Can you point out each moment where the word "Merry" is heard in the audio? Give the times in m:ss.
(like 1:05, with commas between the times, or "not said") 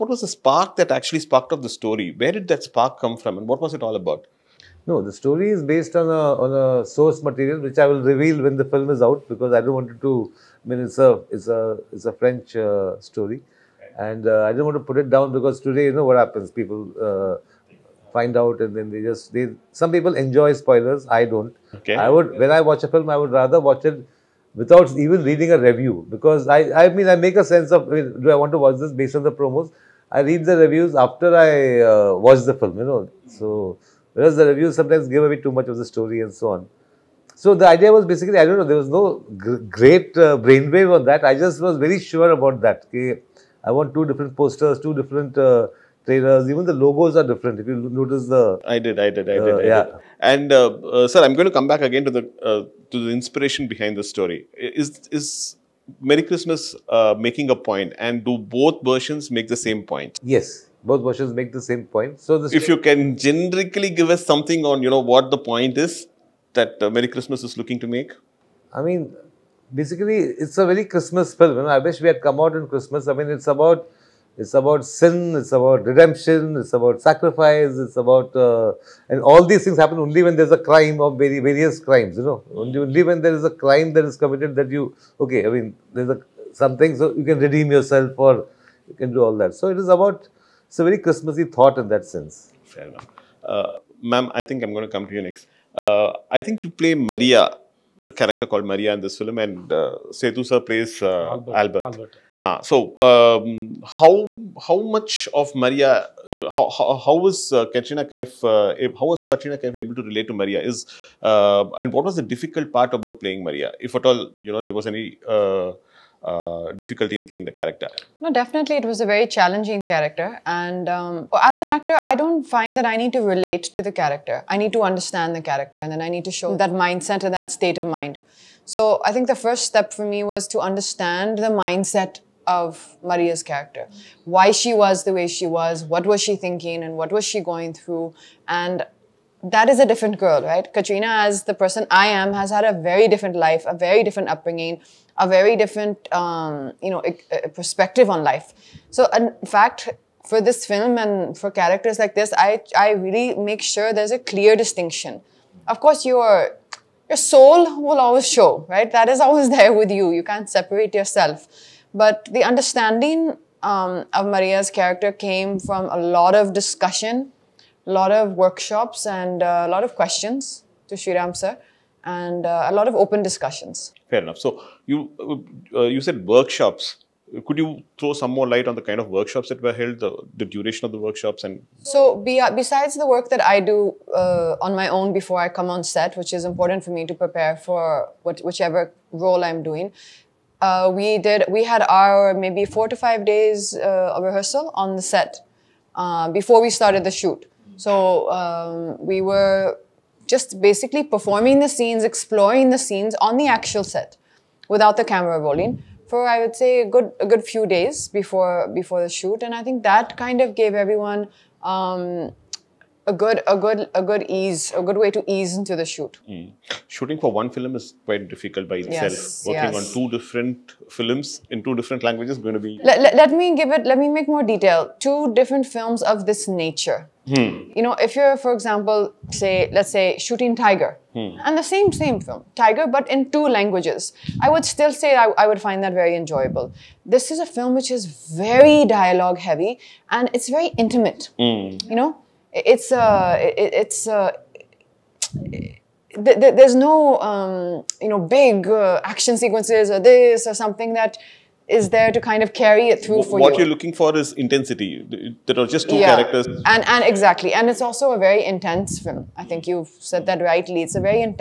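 0:56, 1:06.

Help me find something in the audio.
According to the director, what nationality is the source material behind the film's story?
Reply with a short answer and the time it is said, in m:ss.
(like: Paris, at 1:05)
French, at 0:12.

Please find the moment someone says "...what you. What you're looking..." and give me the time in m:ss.
4:13.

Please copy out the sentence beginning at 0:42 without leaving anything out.
Okay, I want two different posters, two different uh, trainers.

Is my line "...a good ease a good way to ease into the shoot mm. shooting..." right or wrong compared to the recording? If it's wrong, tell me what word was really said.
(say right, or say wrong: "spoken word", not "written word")
right.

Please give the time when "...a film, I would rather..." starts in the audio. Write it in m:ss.
0:22.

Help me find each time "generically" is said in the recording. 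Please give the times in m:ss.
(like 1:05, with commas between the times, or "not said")
1:03.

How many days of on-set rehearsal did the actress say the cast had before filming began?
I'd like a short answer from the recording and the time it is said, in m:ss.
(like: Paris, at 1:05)
4 to 5 days, at 3:12.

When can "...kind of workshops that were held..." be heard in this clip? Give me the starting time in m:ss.
2:58.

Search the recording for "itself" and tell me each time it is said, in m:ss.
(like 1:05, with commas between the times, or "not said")
3:38.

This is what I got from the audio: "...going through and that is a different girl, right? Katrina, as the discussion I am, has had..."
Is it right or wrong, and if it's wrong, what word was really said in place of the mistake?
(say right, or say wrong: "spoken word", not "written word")
wrong: "person", not "discussion".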